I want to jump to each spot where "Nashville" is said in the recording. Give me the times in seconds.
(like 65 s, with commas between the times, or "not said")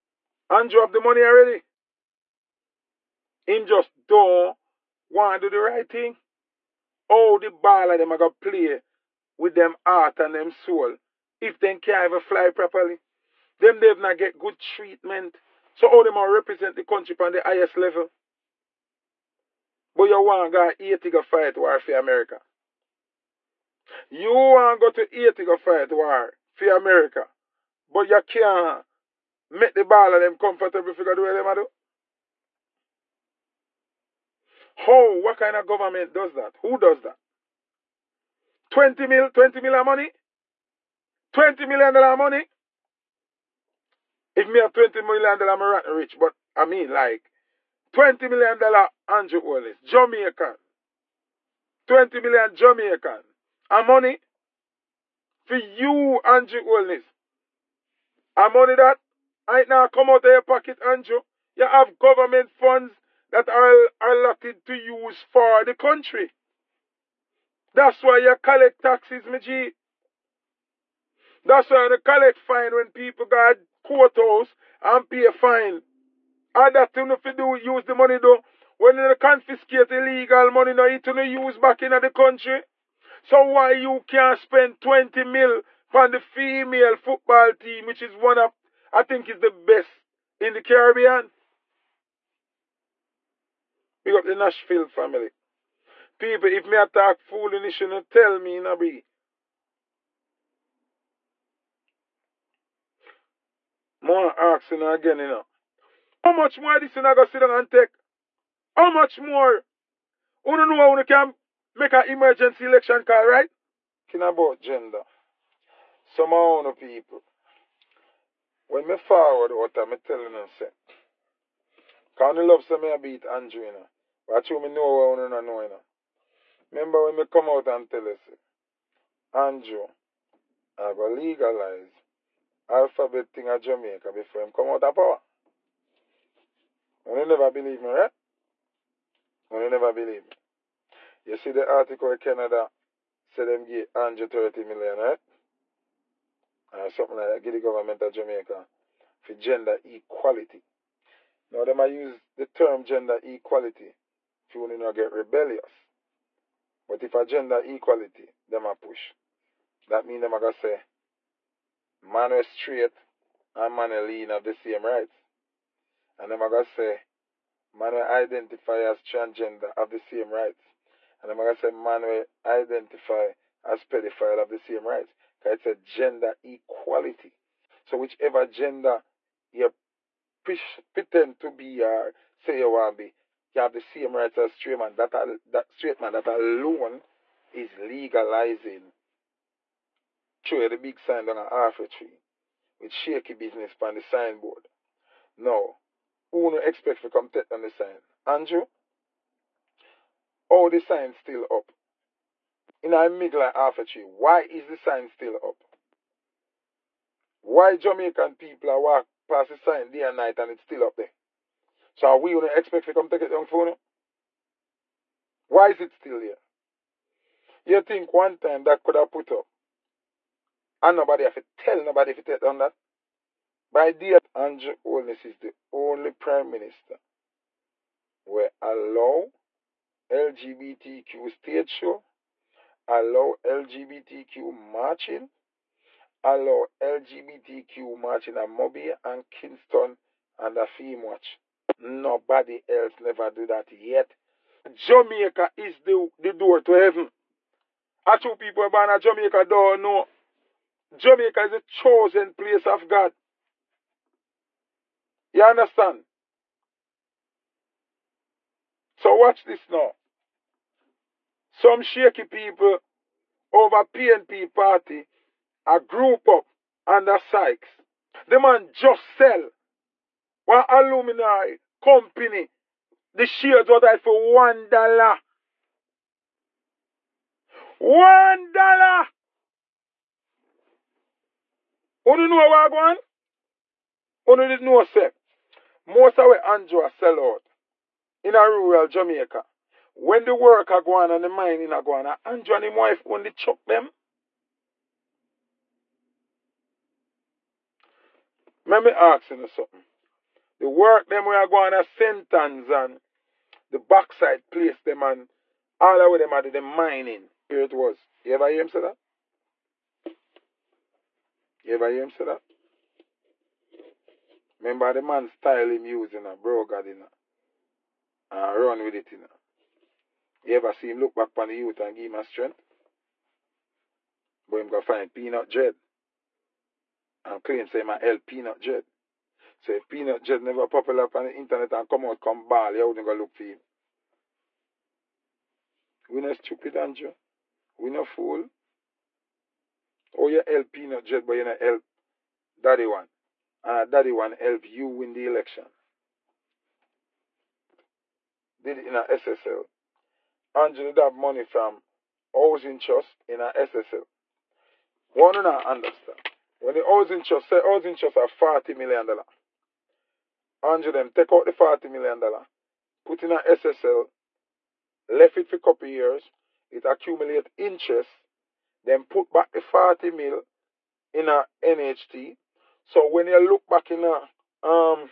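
94 s.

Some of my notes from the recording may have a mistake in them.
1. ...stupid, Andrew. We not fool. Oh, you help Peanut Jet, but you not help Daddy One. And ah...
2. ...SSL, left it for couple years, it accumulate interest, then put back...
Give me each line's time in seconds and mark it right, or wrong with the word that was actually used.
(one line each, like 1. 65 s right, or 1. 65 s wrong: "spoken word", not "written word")
1. 336 s right
2. 363 s right.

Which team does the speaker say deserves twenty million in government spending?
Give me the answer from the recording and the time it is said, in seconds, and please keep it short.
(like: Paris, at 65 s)
female football team, at 86 s.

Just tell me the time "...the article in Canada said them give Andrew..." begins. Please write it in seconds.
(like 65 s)
141 s.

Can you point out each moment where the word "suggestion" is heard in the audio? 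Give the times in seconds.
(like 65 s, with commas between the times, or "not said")
not said.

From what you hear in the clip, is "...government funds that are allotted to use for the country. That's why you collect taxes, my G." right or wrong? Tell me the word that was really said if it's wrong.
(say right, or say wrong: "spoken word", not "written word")
right.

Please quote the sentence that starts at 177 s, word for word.
So whichever gender you pretend to be or say you want to be, you have the same rights as straight man.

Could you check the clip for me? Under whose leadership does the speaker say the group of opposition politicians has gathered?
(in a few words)
Sykes.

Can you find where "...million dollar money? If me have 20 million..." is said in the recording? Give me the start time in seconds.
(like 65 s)
41 s.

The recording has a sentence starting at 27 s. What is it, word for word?
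But you can't make the baller them comfortable figure do what them do.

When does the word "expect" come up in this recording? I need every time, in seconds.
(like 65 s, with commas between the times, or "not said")
196 s, 212 s.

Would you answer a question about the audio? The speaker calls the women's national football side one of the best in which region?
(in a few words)
the Caribbean.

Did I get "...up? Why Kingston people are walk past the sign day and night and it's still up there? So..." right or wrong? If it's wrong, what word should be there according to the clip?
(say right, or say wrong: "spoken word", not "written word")
wrong: "Jamaican", not "Kingston".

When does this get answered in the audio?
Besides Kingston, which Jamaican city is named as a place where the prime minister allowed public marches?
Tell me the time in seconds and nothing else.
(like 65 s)
238 s.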